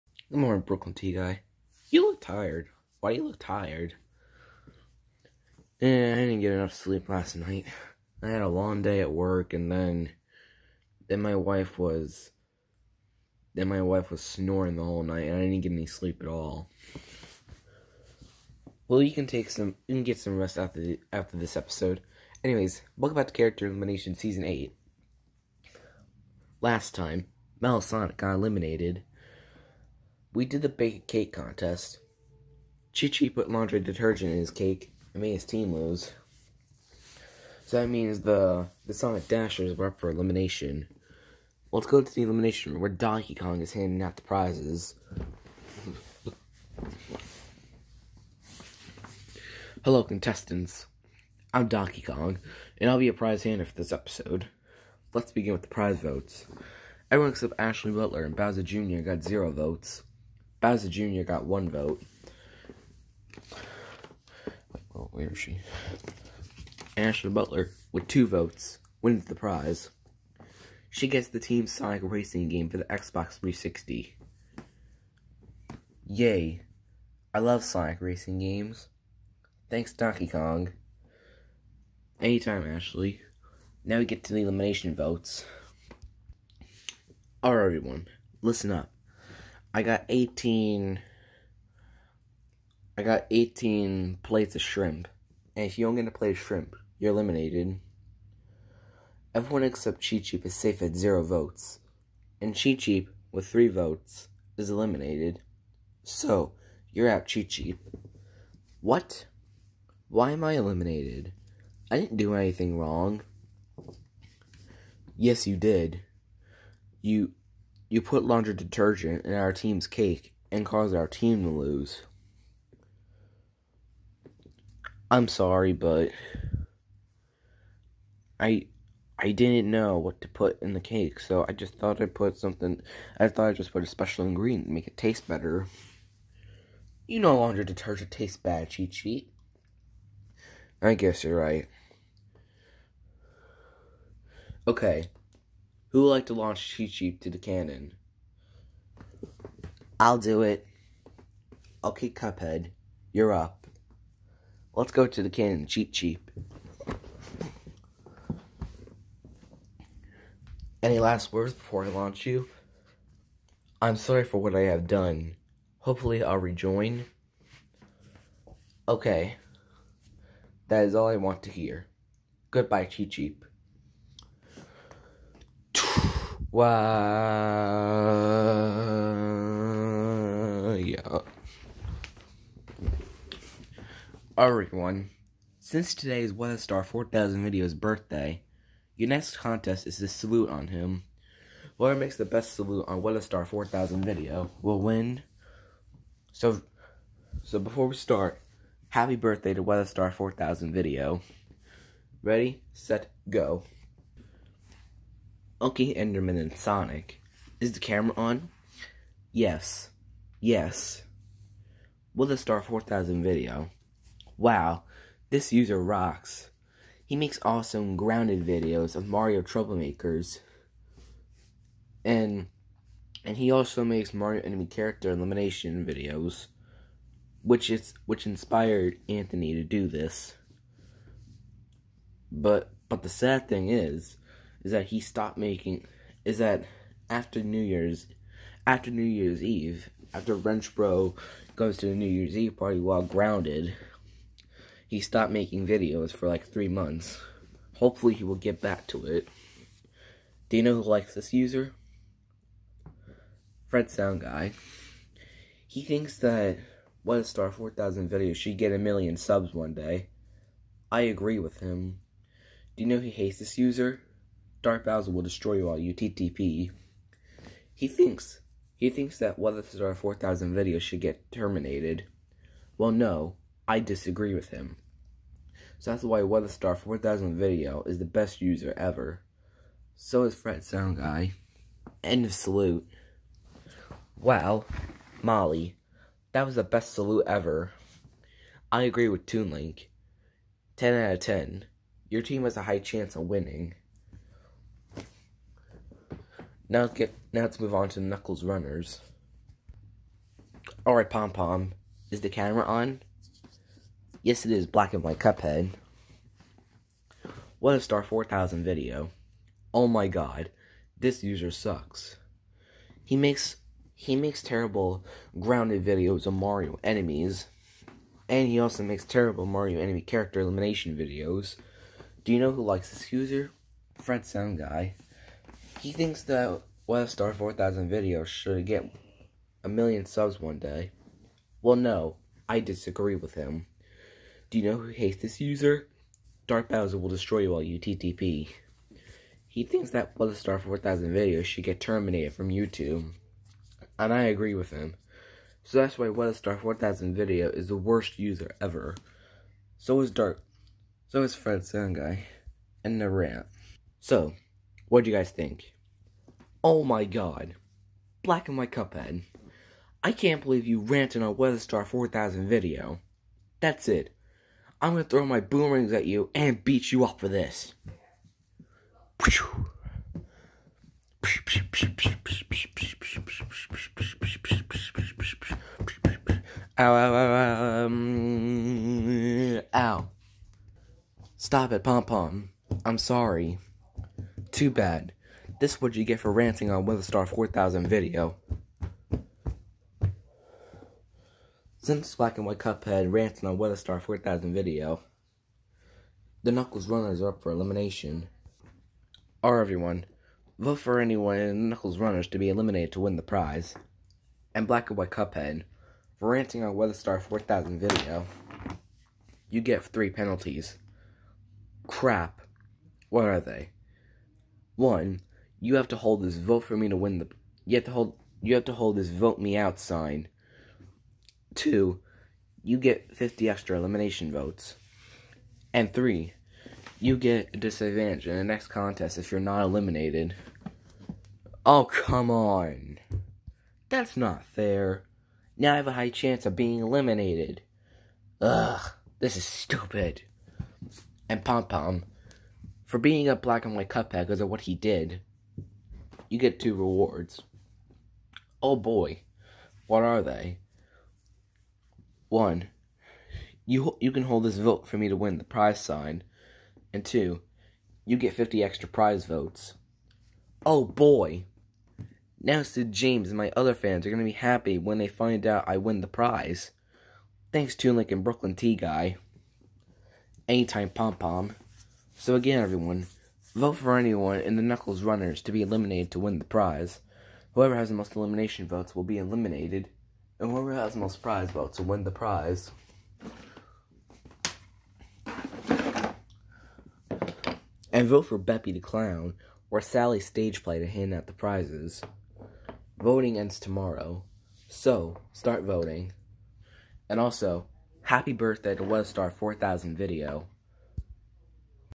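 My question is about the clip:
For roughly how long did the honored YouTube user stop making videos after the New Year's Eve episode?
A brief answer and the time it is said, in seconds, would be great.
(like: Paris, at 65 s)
3 months, at 246 s.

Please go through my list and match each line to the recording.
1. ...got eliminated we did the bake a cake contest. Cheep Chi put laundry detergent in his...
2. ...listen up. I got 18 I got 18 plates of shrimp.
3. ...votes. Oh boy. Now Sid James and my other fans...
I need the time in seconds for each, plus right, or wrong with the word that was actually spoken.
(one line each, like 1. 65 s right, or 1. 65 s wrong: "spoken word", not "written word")
1. 28 s wrong: "Cheep", not "Chi"
2. 88 s right
3. 459 s right.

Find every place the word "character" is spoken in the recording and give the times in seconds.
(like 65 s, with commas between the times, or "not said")
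23 s, 224 s, 319 s.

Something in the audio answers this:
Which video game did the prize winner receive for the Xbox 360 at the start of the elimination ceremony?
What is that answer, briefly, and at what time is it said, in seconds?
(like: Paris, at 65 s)
Team Sonic Racing, at 71 s.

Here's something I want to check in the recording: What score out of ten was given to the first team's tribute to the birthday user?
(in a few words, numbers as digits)
10.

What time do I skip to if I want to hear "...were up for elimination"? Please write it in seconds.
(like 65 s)
39 s.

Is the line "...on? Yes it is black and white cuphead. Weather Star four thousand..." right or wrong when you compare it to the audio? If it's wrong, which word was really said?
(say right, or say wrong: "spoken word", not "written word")
right.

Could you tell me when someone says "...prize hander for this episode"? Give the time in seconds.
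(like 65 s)
53 s.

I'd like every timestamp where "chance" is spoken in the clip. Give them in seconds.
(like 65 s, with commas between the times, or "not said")
292 s, 436 s.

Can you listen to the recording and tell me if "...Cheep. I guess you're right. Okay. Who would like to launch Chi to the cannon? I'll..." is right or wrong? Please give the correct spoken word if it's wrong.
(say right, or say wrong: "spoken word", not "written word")
right.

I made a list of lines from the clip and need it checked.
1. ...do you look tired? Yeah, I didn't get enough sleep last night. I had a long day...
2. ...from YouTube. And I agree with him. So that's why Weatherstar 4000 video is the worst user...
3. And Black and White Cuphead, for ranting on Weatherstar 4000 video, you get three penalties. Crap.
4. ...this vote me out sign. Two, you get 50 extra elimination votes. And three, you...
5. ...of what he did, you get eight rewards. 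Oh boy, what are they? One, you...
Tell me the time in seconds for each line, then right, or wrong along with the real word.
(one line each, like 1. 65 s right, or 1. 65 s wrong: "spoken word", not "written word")
1. 3 s right
2. 342 s right
3. 404 s right
4. 418 s right
5. 444 s wrong: "two", not "eight".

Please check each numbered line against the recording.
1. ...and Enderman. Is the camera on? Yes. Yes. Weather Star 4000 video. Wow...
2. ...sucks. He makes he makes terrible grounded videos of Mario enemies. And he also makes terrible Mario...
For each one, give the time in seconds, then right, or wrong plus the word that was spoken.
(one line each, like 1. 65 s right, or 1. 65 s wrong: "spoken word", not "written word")
1. 206 s wrong: "Sonic", not "Enderman"
2. 311 s right.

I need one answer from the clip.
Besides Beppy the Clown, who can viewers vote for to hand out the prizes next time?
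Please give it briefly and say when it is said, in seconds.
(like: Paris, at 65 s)
Sally Stage Play, at 489 s.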